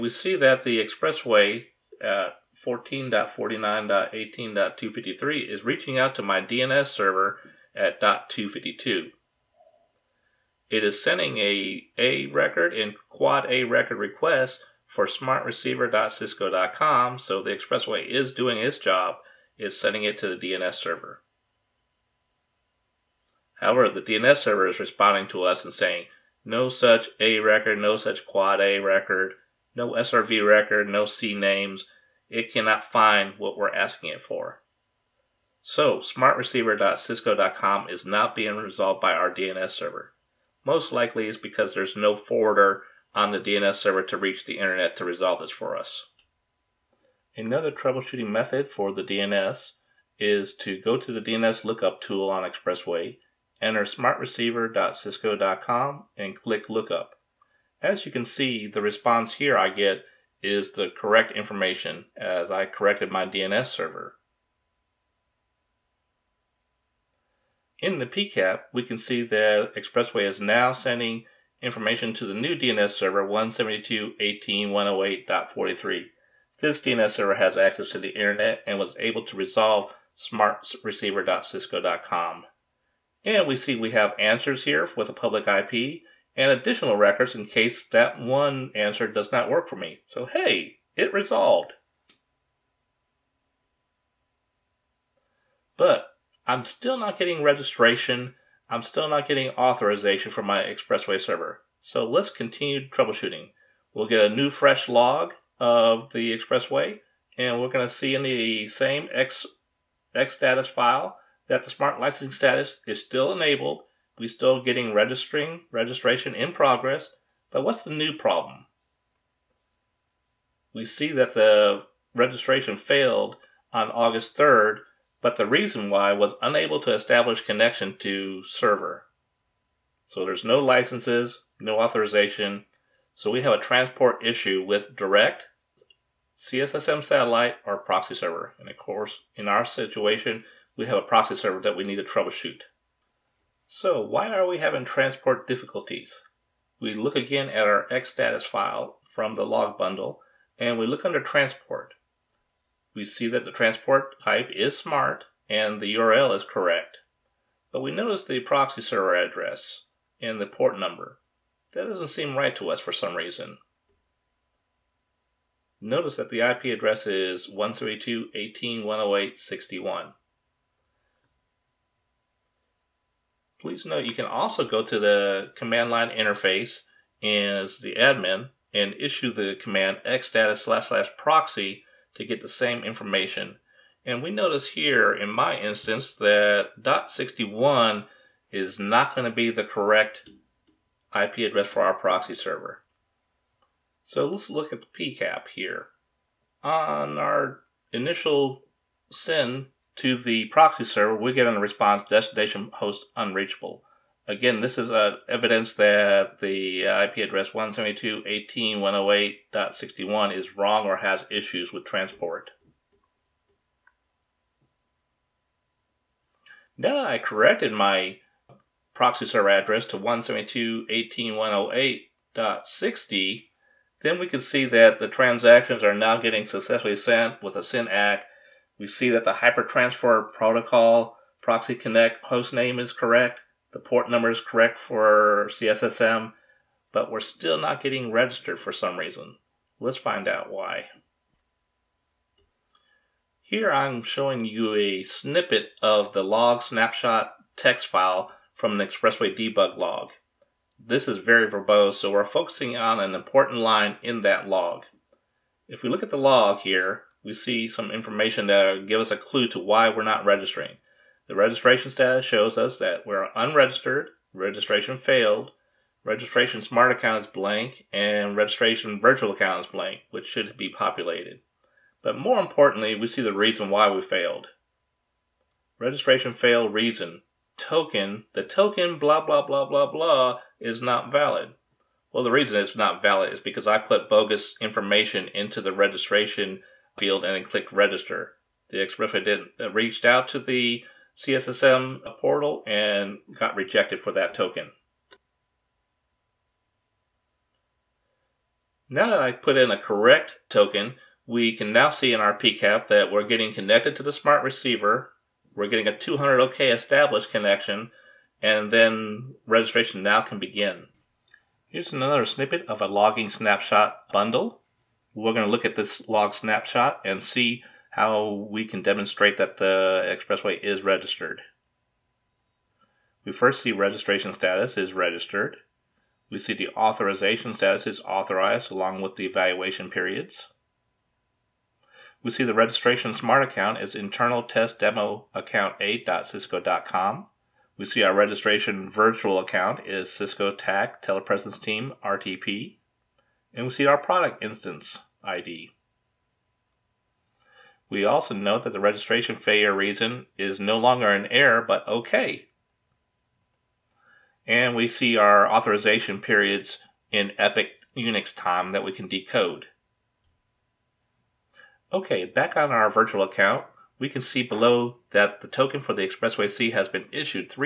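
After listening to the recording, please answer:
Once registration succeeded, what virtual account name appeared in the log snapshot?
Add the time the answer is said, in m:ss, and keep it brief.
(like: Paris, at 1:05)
Cisco TAC Telepresence Team RTP, at 5:40.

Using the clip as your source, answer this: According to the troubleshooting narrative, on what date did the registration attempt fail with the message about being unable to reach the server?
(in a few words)
August 3rd.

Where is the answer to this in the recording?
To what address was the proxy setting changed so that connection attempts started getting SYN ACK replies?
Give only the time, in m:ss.
3:39.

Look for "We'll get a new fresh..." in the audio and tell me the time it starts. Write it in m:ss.
1:43.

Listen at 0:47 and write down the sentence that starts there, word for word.
Another troubleshooting method for the DNS is to go to the DNS lookup tool on Expressway, enter smartreceiver.cisco.com, and click lookup.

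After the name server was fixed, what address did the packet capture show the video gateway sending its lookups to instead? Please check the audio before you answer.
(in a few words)
172.18.108.43.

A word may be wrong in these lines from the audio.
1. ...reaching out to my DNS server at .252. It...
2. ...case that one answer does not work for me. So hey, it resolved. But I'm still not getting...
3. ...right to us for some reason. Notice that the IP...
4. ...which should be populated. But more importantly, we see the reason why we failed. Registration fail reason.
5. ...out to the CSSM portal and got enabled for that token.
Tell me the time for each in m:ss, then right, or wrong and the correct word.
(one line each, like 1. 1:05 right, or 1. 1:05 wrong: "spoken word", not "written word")
1. 0:05 right
2. 1:27 right
3. 2:42 right
4. 4:30 right
5. 4:50 wrong: "rejected", not "enabled".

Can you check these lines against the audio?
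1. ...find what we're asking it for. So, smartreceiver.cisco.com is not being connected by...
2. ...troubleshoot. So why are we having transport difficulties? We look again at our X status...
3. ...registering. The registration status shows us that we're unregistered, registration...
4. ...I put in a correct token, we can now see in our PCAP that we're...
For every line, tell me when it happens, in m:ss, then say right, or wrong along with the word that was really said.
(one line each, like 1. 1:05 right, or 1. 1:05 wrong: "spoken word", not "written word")
1. 0:32 wrong: "resolved", not "connected"
2. 2:22 right
3. 4:20 right
4. 4:59 right.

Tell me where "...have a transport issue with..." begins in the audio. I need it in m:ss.
2:13.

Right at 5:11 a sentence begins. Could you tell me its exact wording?
Here's another snippet of a logging snapshot bundle.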